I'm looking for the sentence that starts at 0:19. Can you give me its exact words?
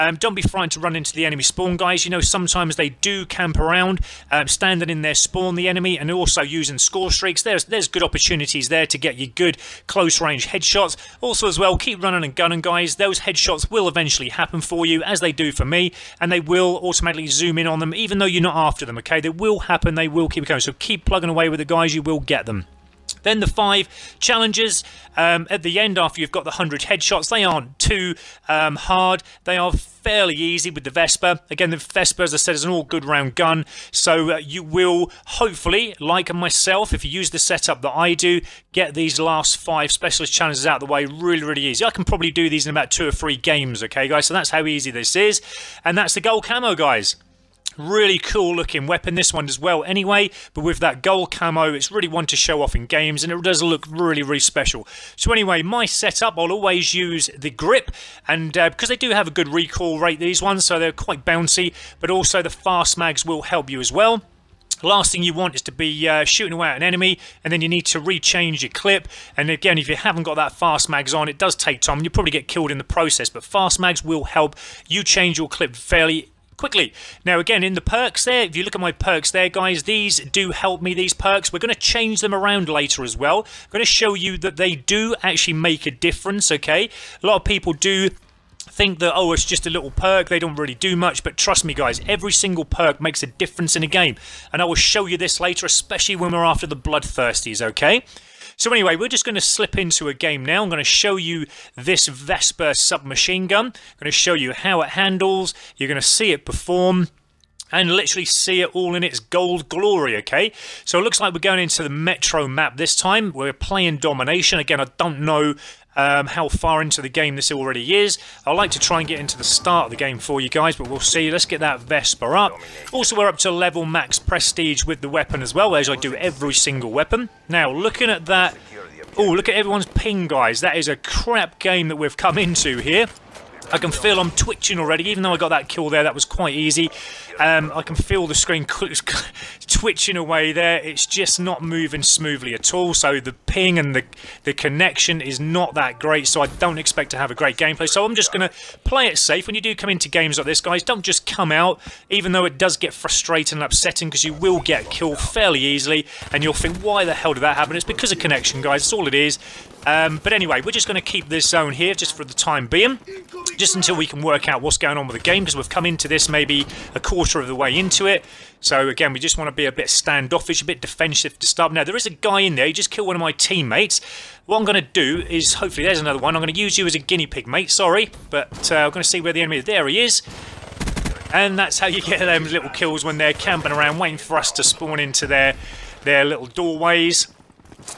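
They will happen, they will keep coming.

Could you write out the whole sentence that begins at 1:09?
And again, if you haven't got that fast mags on, it does take time.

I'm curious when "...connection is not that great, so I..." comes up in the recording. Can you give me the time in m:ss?
2:24.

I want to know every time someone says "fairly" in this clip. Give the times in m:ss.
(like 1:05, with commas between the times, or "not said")
0:29, 1:15, 2:35.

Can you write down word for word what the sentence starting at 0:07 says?
There's, there's good opportunities there to get you good close-range headshots.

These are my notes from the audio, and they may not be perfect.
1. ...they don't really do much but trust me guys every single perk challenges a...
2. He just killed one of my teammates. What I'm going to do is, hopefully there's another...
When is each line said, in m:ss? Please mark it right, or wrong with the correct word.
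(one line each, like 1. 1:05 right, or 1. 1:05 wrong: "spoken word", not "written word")
1. 1:30 wrong: "makes", not "challenges"
2. 2:52 right.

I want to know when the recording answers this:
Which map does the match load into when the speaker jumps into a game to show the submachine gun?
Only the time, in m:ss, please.
1:51.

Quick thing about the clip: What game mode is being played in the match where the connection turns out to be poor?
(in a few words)
Domination.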